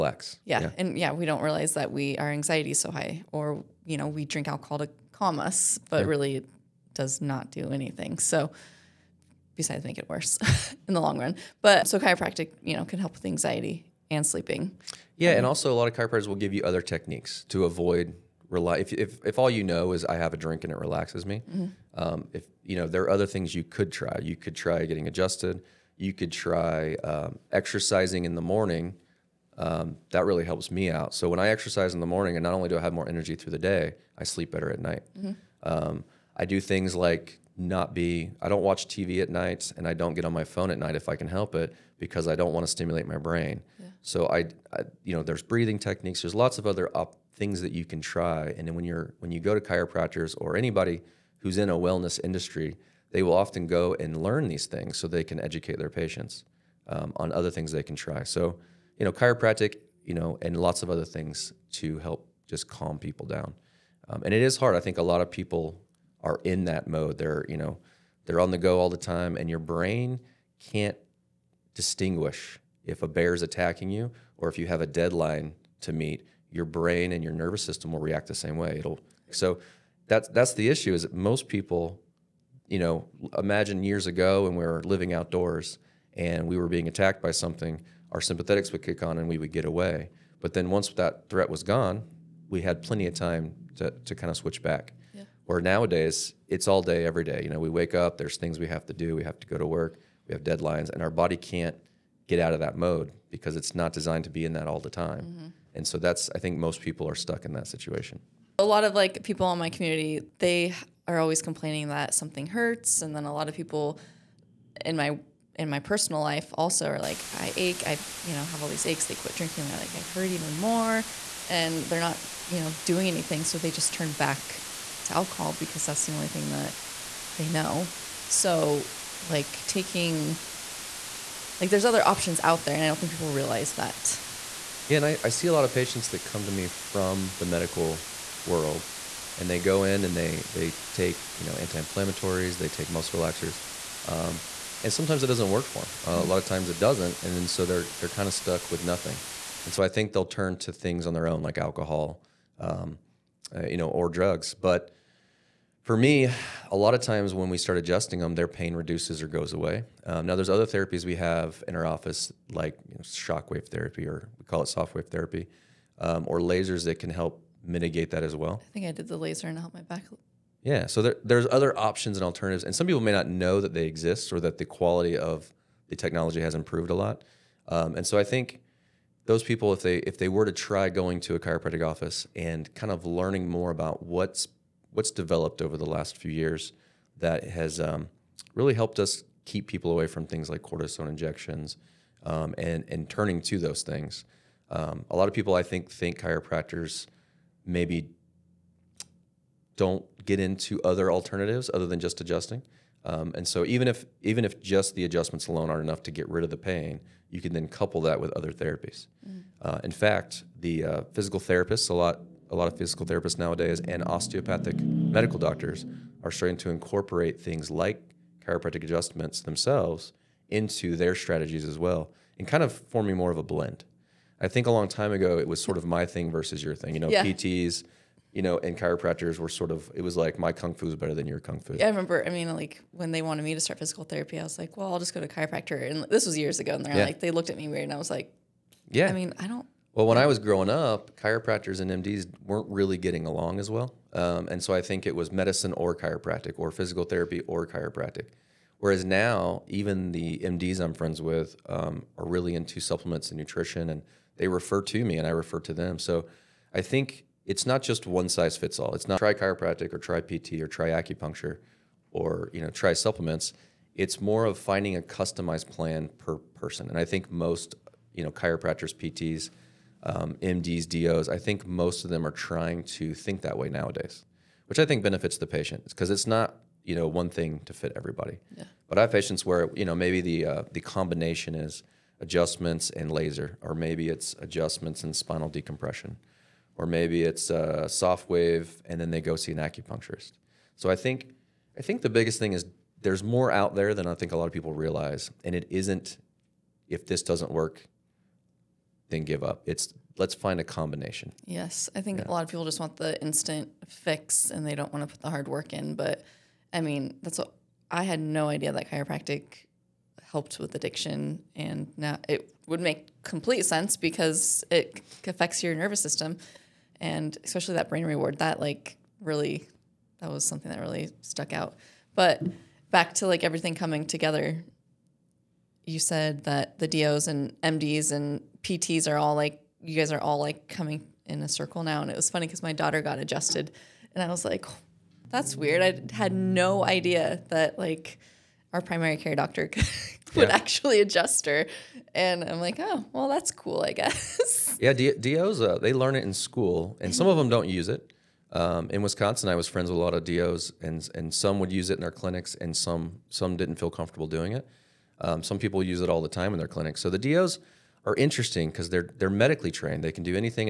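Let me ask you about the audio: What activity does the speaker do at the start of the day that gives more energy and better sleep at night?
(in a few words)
Exercising in the morning.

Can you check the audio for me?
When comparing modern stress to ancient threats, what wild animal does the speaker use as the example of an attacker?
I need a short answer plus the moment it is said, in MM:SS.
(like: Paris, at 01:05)
A bear, at 01:13.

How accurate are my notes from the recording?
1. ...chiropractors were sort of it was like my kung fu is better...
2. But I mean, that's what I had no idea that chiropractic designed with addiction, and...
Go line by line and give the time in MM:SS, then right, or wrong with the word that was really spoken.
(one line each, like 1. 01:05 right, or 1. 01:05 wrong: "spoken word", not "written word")
1. 03:48 right
2. 05:05 wrong: "helped", not "designed".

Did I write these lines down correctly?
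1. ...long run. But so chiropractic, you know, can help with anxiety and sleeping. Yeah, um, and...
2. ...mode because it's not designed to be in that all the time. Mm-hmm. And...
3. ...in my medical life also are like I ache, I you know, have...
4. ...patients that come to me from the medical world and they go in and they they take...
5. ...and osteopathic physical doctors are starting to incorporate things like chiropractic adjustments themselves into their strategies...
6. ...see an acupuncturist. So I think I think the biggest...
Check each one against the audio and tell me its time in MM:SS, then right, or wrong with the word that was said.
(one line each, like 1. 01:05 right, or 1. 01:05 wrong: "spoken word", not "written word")
1. 00:11 right
2. 01:42 right
3. 01:55 wrong: "personal", not "medical"
4. 02:15 right
5. 03:33 wrong: "medical", not "physical"
6. 04:49 right.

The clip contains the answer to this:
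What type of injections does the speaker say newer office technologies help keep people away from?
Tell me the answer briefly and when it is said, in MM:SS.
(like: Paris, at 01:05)
Cortisone injections, at 03:10.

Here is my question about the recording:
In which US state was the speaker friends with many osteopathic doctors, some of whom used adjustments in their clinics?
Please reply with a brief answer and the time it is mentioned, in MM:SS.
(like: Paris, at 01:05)
Wisconsin, at 05:49.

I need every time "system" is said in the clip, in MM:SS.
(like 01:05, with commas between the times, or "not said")
01:17, 05:16.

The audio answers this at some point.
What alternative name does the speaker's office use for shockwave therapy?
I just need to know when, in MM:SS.
02:44.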